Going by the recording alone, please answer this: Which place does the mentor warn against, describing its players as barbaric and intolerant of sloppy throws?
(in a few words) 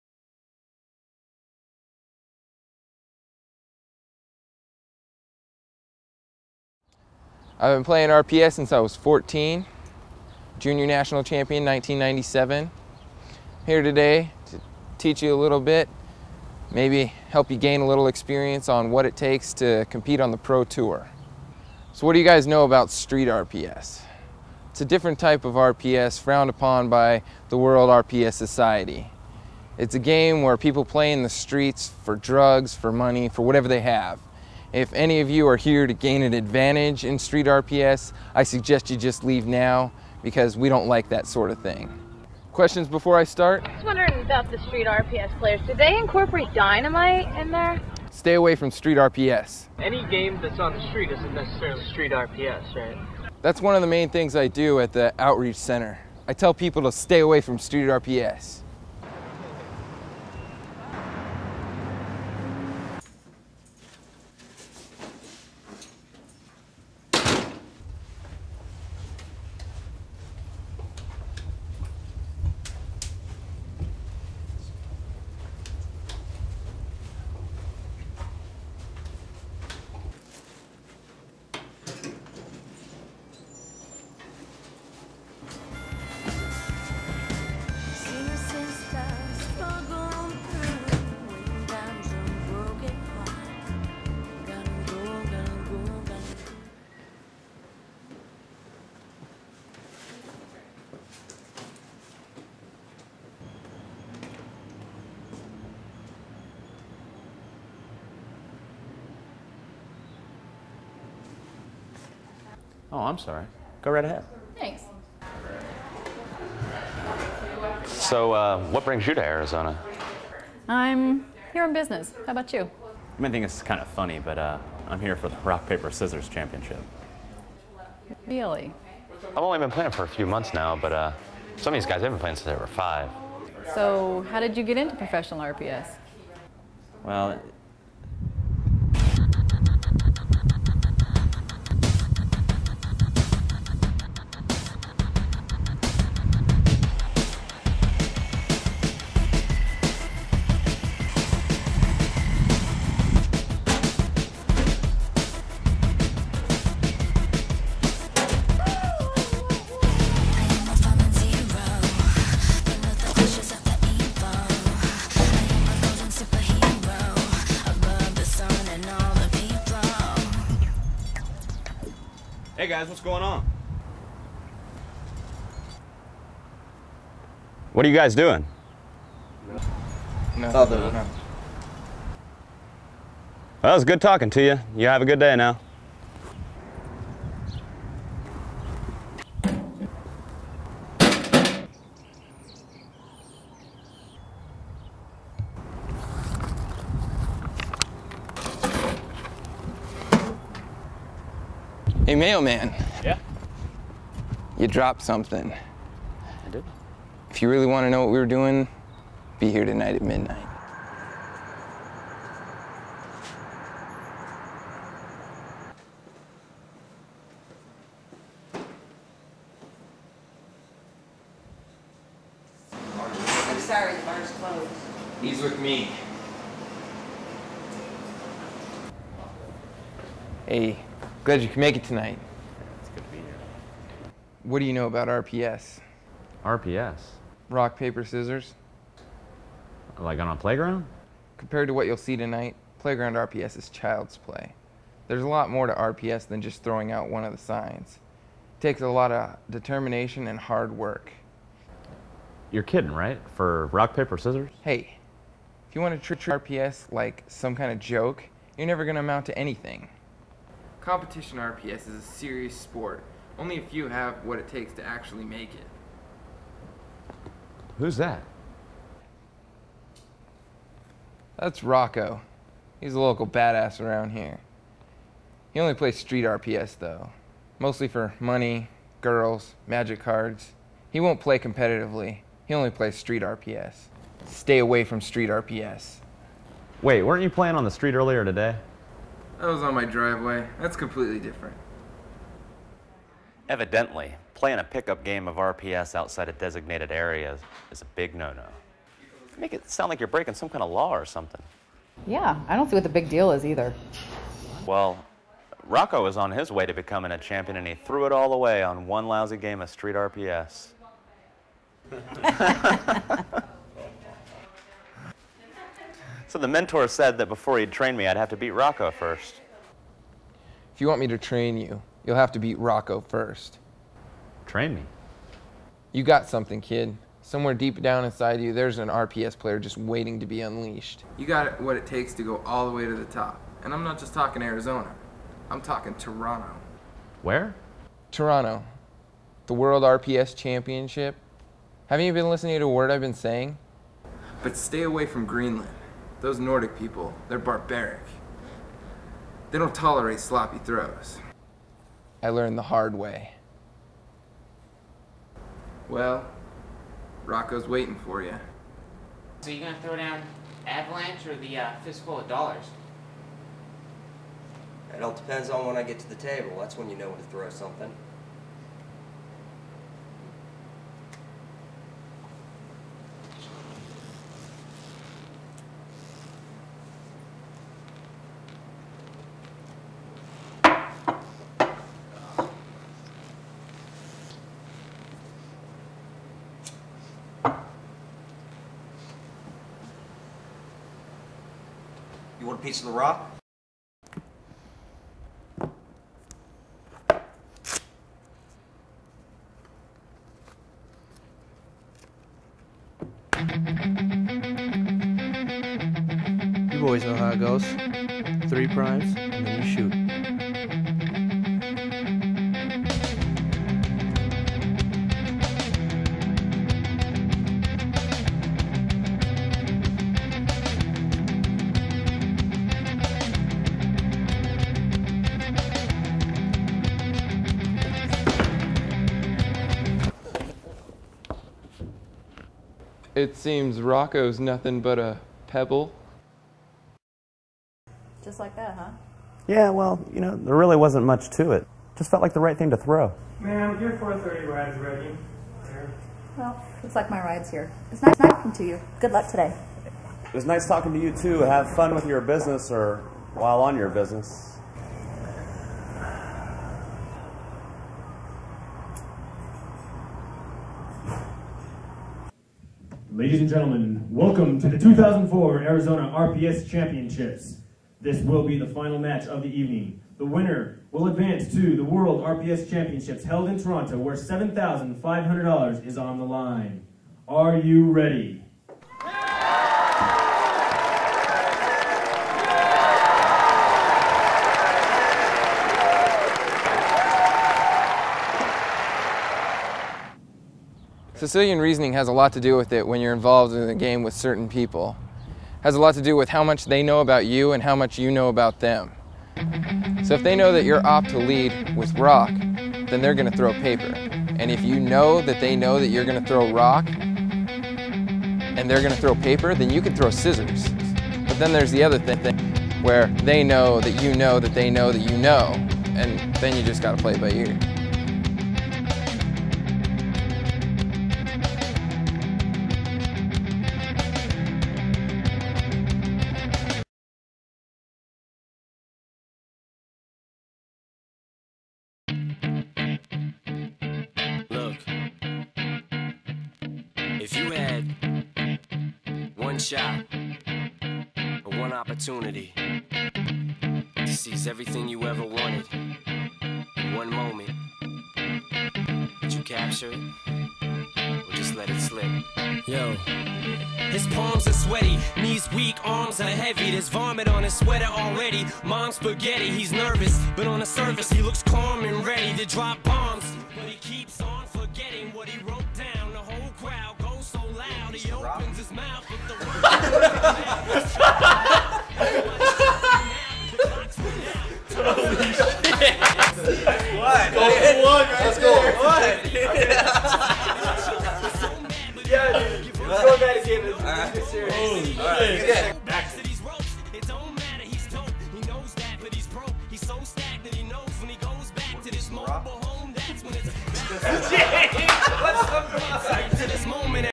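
Greenland.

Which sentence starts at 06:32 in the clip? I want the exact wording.
You want a piece of the rock?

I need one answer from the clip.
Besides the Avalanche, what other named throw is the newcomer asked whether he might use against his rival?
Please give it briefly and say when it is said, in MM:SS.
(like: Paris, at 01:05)
Fistful of dollars, at 06:01.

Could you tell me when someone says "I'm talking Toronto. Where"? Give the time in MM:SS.
05:35.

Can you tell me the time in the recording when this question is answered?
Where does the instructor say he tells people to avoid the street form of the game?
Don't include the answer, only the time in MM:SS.
00:55.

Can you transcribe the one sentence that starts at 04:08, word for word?
It takes a lot of determination and hard work.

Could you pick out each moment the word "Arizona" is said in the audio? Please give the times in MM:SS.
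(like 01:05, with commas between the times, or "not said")
01:59, 05:34, 07:45.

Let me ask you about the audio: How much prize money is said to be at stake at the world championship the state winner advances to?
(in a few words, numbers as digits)
$7,500.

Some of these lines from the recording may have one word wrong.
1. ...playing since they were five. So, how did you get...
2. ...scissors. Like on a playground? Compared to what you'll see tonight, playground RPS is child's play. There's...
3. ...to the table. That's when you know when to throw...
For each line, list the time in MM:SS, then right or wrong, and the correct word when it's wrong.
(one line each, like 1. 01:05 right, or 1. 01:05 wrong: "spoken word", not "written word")
1. 02:12 right
2. 03:58 right
3. 06:05 right.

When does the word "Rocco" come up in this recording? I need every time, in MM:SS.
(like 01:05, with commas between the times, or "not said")
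04:31, 05:05, 05:18, 05:22, 05:57, 07:13.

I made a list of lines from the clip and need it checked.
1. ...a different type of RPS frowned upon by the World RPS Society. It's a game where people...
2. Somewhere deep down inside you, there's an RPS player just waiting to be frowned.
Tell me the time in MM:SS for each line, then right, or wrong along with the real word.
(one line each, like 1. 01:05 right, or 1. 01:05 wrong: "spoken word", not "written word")
1. 00:24 right
2. 05:27 wrong: "unleashed", not "frowned".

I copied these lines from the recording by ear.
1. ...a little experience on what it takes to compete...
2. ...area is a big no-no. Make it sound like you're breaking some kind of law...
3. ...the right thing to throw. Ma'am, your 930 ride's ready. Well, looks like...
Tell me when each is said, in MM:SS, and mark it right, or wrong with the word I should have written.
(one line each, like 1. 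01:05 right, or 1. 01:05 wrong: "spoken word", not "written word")
1. 00:17 right
2. 04:56 right
3. 07:22 wrong: "430", not "930".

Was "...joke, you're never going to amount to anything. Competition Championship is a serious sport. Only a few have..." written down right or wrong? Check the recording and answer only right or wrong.
wrong.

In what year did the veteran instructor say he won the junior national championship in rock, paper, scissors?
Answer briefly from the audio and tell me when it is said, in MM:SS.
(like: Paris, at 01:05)
1997, at 00:11.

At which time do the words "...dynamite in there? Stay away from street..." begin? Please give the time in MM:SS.
00:46.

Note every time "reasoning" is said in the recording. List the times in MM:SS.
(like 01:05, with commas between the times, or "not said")
08:11.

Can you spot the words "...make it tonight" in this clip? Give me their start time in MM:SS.
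03:51.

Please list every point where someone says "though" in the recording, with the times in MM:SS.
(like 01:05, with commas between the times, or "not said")
04:36.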